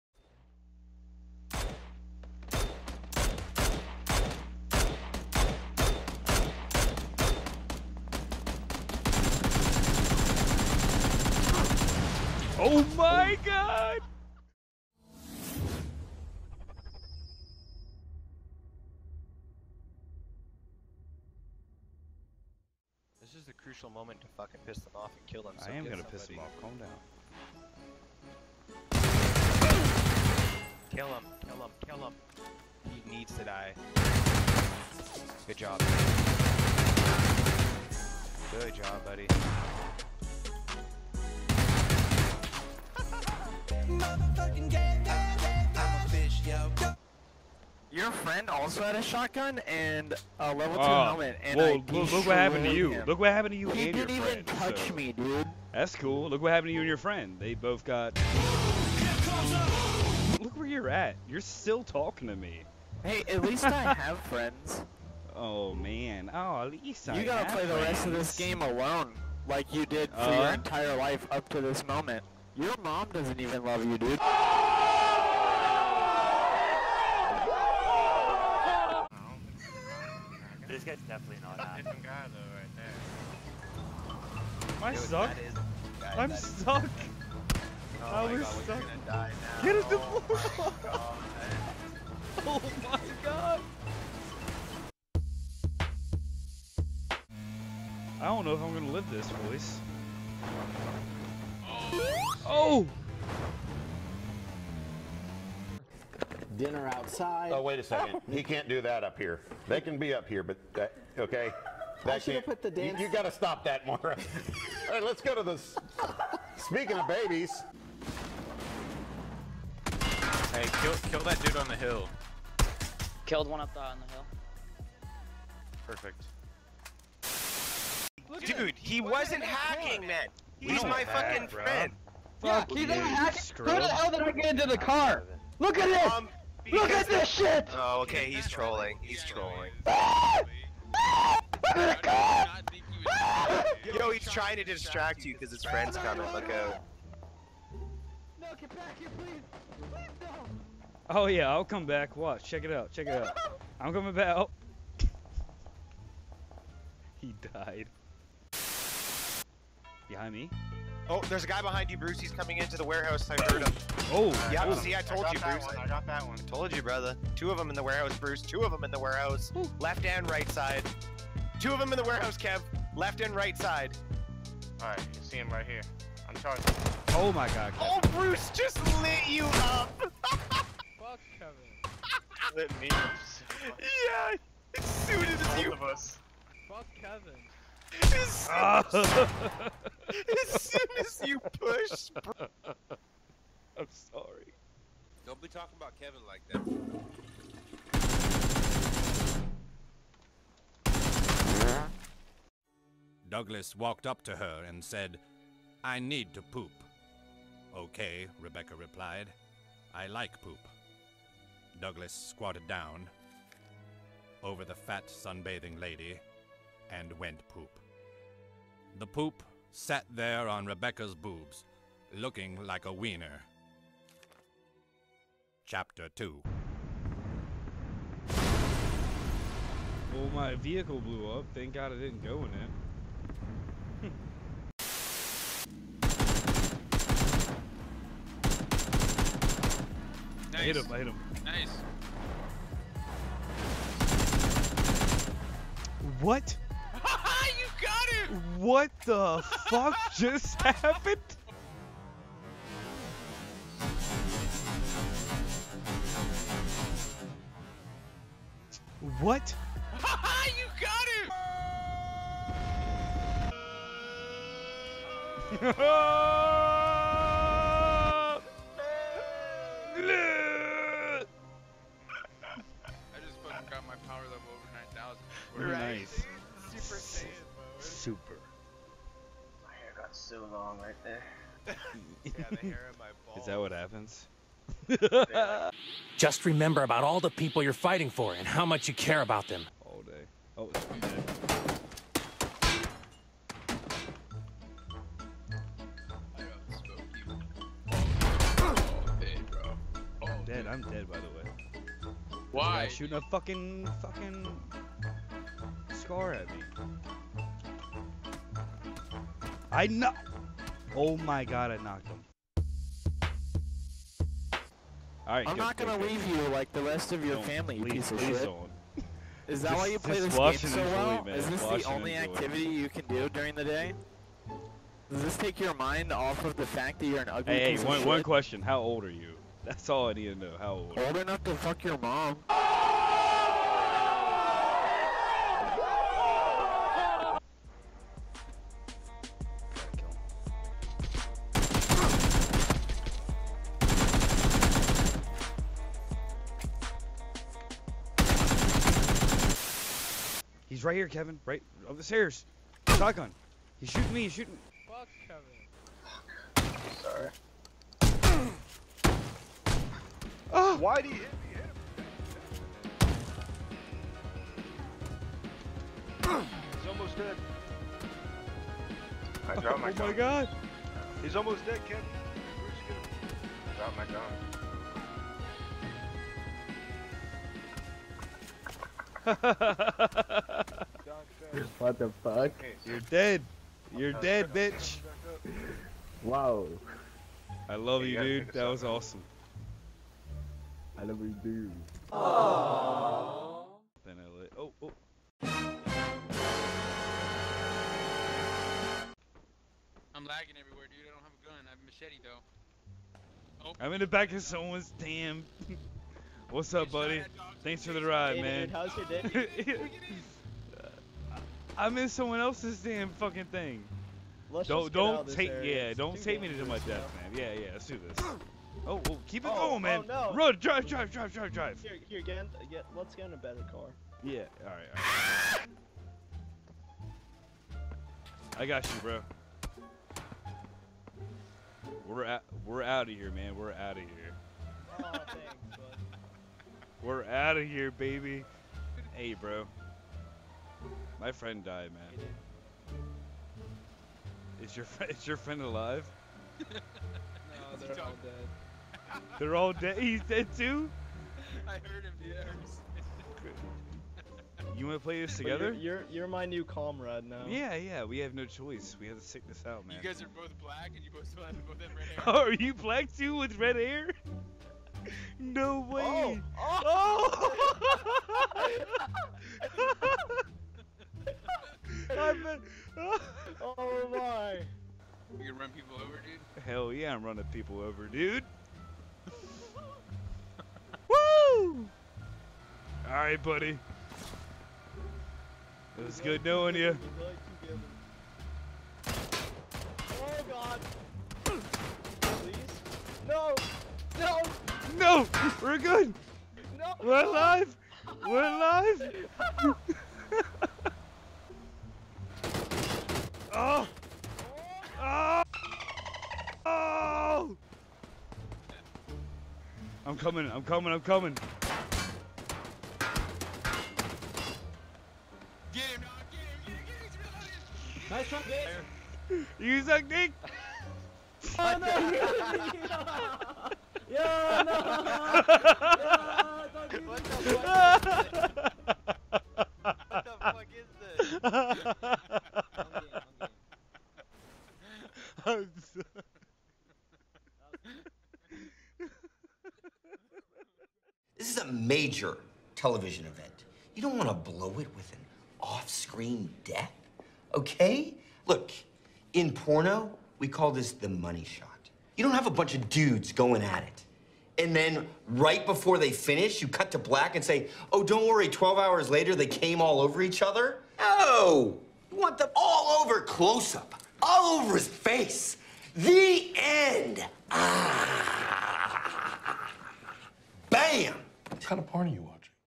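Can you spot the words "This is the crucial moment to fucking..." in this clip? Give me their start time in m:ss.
0:23.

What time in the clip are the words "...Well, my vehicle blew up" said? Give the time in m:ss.
3:50.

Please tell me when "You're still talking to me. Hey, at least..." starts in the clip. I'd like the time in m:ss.
1:01.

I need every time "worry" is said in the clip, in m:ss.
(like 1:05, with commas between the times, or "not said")
9:18.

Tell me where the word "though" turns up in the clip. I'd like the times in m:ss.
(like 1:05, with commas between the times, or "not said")
1:22, 6:42.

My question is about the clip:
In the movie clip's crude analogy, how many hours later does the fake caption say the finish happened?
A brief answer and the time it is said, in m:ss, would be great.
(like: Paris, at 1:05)
12, at 9:18.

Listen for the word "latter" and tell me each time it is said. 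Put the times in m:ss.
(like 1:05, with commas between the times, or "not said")
not said.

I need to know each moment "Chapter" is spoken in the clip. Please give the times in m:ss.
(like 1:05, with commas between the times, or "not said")
3:45.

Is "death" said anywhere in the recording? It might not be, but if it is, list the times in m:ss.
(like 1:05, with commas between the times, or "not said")
6:56, 9:06.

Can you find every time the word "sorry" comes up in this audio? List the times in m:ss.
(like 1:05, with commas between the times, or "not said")
3:13, 5:58.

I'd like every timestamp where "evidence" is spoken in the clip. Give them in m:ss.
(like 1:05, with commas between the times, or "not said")
not said.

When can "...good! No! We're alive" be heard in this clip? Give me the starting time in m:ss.
8:15.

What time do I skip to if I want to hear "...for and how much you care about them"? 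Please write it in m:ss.
4:48.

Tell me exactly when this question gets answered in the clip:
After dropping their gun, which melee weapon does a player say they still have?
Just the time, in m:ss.
6:41.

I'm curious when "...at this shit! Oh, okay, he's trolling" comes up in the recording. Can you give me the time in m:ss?
2:16.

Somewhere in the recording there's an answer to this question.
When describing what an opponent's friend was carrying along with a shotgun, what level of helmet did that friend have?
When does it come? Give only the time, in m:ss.
0:50.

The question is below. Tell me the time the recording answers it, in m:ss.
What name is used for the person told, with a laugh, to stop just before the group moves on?
1:53.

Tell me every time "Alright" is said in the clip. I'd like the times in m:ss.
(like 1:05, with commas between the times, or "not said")
5:15, 8:03.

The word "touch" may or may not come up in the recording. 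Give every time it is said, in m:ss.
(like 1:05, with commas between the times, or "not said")
0:54.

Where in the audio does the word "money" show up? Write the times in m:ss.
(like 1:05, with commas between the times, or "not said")
9:11.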